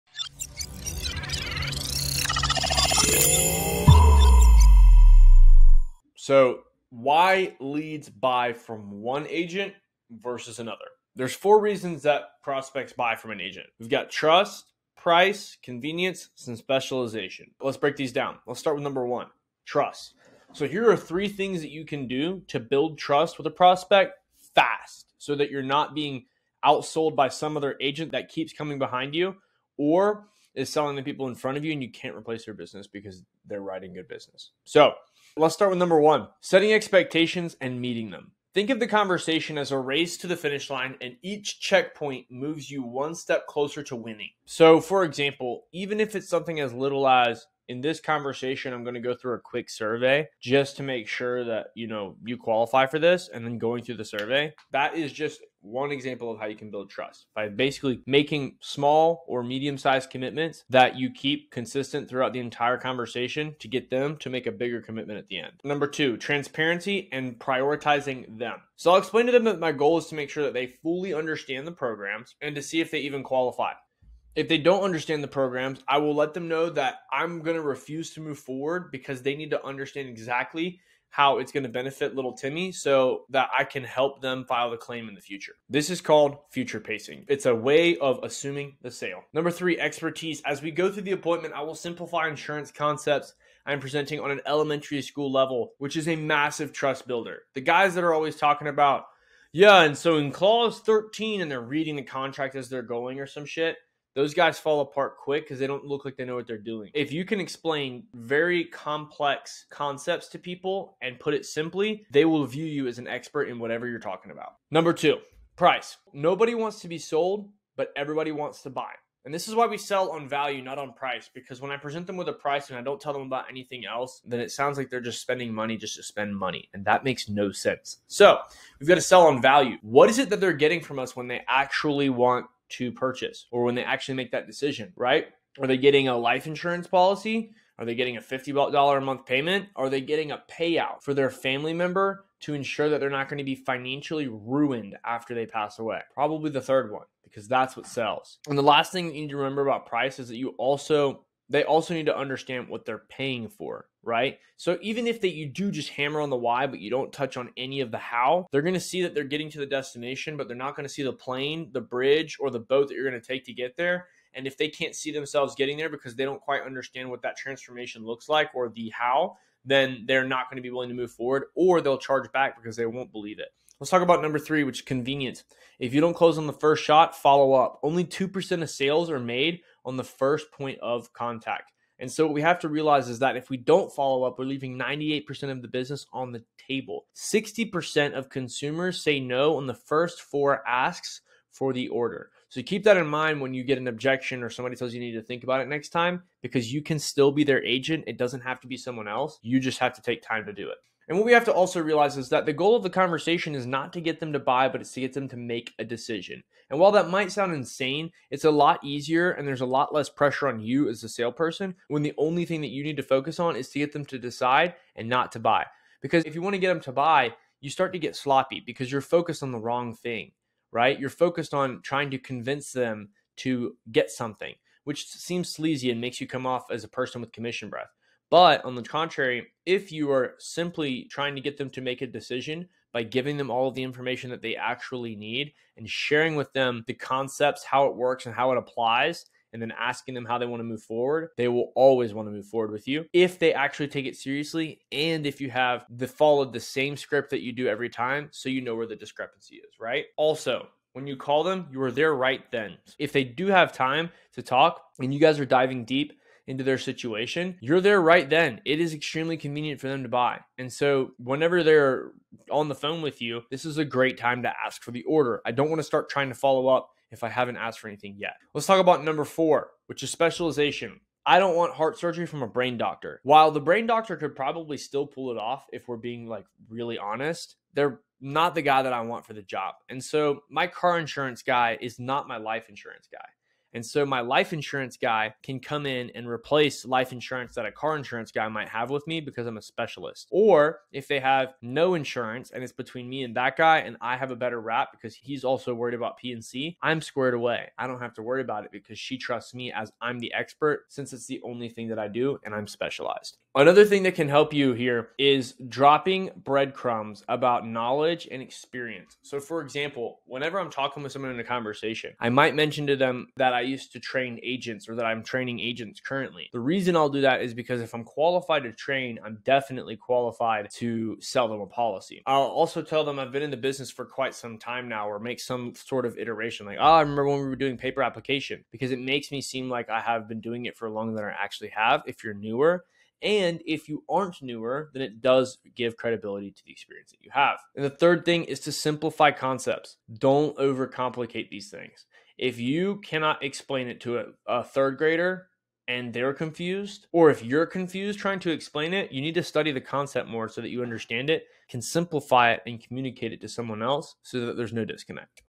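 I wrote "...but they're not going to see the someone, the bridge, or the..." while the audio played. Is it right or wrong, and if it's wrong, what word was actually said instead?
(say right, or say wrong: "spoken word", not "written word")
wrong: "plane", not "someone".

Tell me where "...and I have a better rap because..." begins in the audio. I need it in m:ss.
4:53.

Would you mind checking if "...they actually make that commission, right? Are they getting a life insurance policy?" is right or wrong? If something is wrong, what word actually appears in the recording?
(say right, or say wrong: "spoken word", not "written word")
wrong: "decision", not "commission".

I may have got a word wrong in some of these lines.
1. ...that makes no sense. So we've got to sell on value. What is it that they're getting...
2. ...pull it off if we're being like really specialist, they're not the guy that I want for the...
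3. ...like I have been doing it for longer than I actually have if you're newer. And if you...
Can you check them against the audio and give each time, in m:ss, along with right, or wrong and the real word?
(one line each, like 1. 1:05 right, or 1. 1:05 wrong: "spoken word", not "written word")
1. 2:06 right
2. 4:35 wrong: "honest", not "specialist"
3. 5:29 right.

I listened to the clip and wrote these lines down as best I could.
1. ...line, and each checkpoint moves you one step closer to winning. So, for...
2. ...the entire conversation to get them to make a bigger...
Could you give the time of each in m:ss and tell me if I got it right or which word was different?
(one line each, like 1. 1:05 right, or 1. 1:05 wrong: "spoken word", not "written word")
1. 0:40 right
2. 1:02 right.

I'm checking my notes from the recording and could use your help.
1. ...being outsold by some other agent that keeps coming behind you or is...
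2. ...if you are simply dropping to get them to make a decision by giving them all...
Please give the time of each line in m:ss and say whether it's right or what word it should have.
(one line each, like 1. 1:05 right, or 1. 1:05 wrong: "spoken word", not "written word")
1. 0:25 right
2. 3:49 wrong: "trying", not "dropping".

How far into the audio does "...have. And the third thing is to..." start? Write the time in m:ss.
5:37.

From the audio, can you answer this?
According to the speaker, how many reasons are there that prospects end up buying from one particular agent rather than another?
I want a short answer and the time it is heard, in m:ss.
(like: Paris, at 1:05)
4, at 0:11.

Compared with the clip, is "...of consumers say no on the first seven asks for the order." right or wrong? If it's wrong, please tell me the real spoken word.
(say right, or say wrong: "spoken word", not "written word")
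wrong: "four", not "seven".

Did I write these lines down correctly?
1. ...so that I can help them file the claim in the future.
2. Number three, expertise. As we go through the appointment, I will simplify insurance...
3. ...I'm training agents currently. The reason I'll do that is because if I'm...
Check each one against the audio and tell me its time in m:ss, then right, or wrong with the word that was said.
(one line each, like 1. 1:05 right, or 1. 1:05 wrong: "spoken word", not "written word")
1. 1:22 right
2. 1:29 right
3. 5:15 right.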